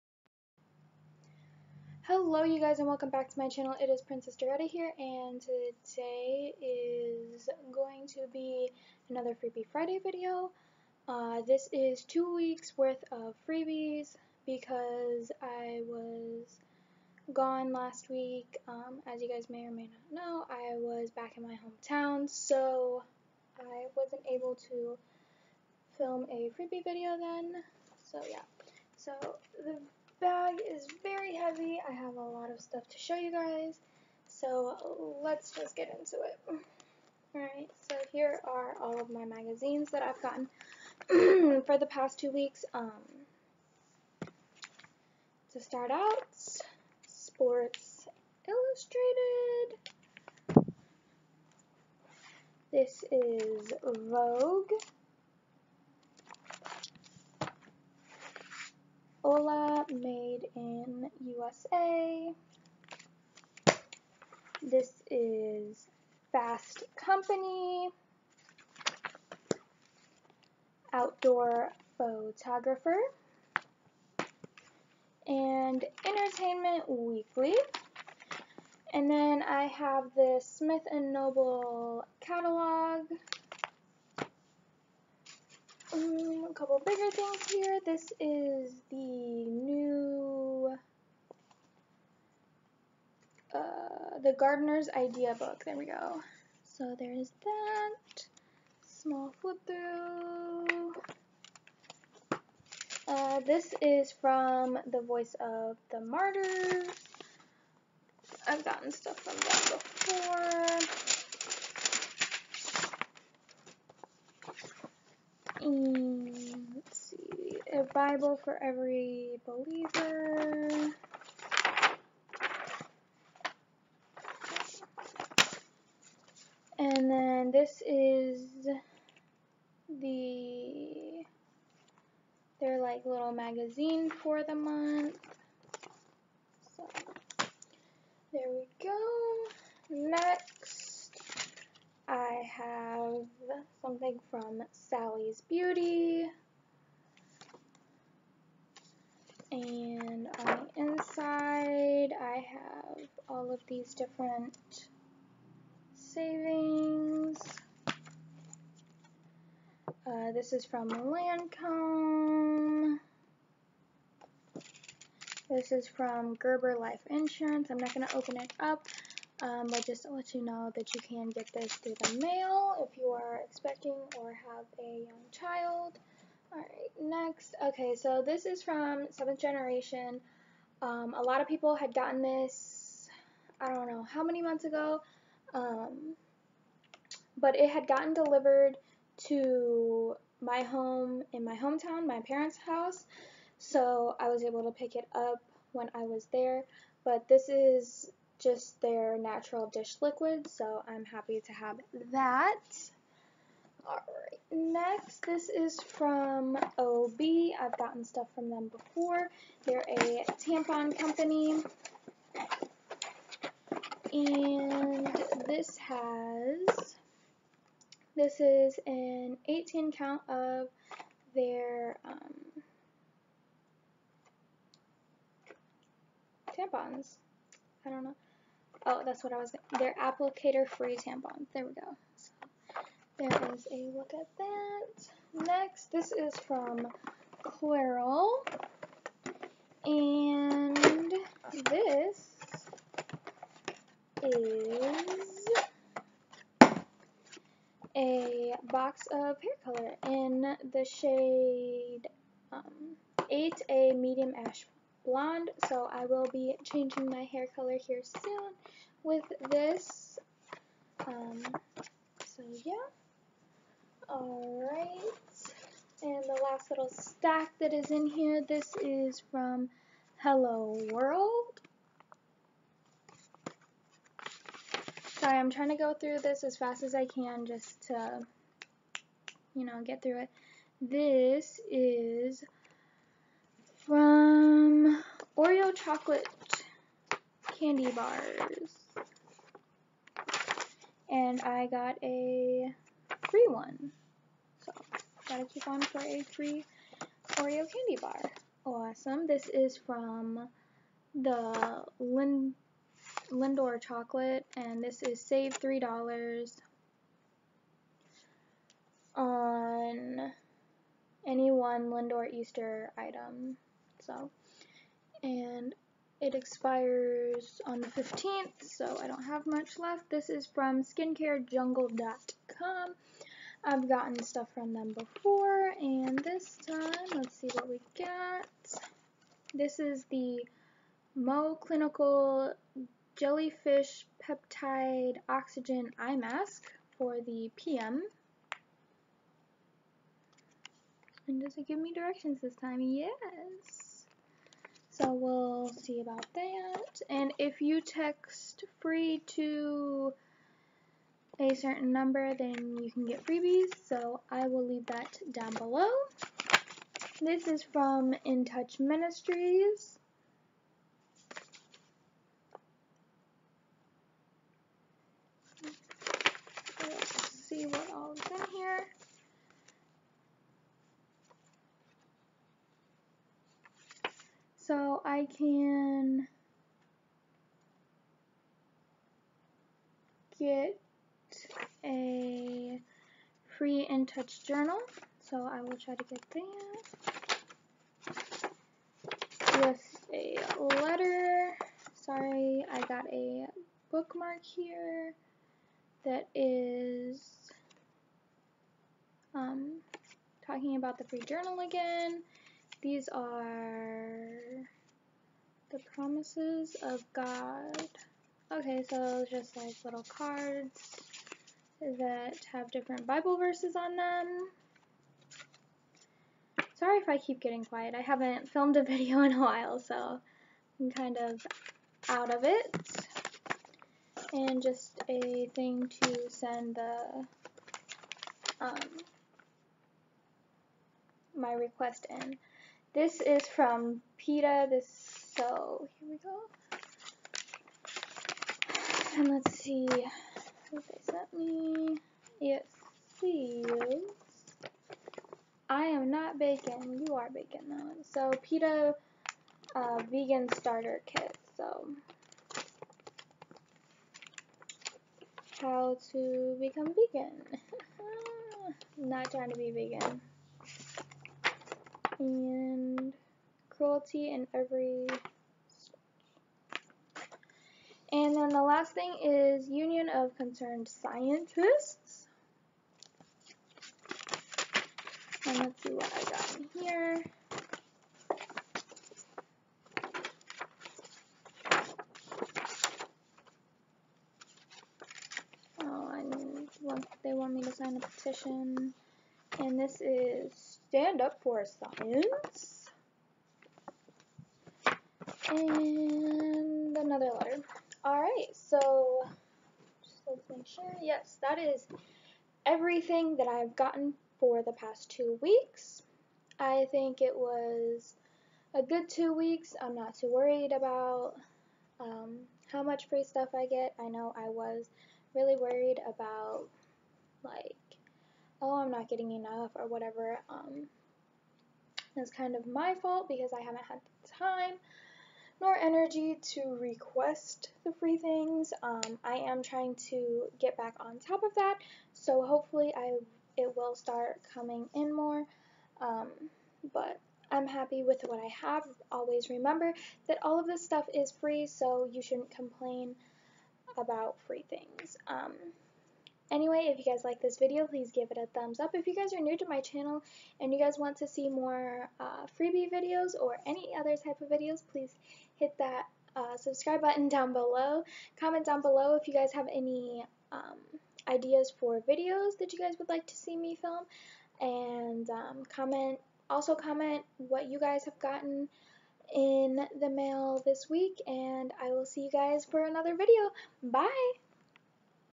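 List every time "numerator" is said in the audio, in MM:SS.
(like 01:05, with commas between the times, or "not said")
not said.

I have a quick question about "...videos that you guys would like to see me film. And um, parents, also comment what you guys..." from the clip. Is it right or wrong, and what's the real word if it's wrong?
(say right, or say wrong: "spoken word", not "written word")
wrong: "comment", not "parents".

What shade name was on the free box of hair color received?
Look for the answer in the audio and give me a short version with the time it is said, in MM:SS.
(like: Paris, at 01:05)
medium ash blonde, at 04:13.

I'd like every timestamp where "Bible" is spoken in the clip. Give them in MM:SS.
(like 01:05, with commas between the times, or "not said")
01:57, 06:53.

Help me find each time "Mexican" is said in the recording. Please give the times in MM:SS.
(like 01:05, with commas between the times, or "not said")
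not said.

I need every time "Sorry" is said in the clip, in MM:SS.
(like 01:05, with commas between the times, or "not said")
04:35, 06:31, 06:56.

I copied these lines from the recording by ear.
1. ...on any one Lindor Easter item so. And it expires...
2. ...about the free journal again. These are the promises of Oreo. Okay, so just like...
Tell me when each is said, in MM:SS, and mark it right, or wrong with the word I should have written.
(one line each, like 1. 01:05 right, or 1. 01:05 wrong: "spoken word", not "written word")
1. 05:09 right
2. 06:40 wrong: "God", not "Oreo".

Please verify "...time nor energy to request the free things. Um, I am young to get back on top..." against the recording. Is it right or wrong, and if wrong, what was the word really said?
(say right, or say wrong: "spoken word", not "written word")
wrong: "trying", not "young".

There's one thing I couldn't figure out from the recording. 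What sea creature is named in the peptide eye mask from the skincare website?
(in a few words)
Jellyfish.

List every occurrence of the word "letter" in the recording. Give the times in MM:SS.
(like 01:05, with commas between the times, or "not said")
06:30, 08:17.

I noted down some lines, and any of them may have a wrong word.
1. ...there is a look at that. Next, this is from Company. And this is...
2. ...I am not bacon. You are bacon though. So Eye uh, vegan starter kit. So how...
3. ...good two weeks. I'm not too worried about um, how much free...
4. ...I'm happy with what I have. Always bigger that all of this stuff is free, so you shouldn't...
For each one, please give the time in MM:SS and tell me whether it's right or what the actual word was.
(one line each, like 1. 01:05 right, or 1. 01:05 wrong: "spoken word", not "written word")
1. 03:53 wrong: "Clairol", not "Company"
2. 07:25 wrong: "PETA", not "Eye"
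3. 08:28 right
4. 08:57 wrong: "remember", not "bigger".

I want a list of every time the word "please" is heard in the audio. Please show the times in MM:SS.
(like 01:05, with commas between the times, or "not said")
09:07, 09:14.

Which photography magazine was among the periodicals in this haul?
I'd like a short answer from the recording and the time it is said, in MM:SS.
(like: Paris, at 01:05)
Outdoor Photographer, at 01:10.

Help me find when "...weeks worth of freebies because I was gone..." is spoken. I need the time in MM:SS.
00:12.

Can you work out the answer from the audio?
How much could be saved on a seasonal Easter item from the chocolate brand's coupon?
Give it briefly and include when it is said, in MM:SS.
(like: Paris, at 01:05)
$3, at 05:05.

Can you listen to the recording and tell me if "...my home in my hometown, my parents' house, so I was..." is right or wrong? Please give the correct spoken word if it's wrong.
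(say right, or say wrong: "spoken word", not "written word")
right.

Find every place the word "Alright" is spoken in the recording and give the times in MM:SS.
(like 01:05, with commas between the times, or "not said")
00:37, 02:56, 03:23, 04:24, 08:18.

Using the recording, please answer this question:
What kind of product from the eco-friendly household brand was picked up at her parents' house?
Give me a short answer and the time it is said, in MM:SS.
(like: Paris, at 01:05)
natural dish liquid, at 03:19.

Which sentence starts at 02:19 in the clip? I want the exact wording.
Next I have something from Sally's Beauty.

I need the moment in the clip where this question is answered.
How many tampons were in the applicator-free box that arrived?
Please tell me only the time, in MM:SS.
03:39.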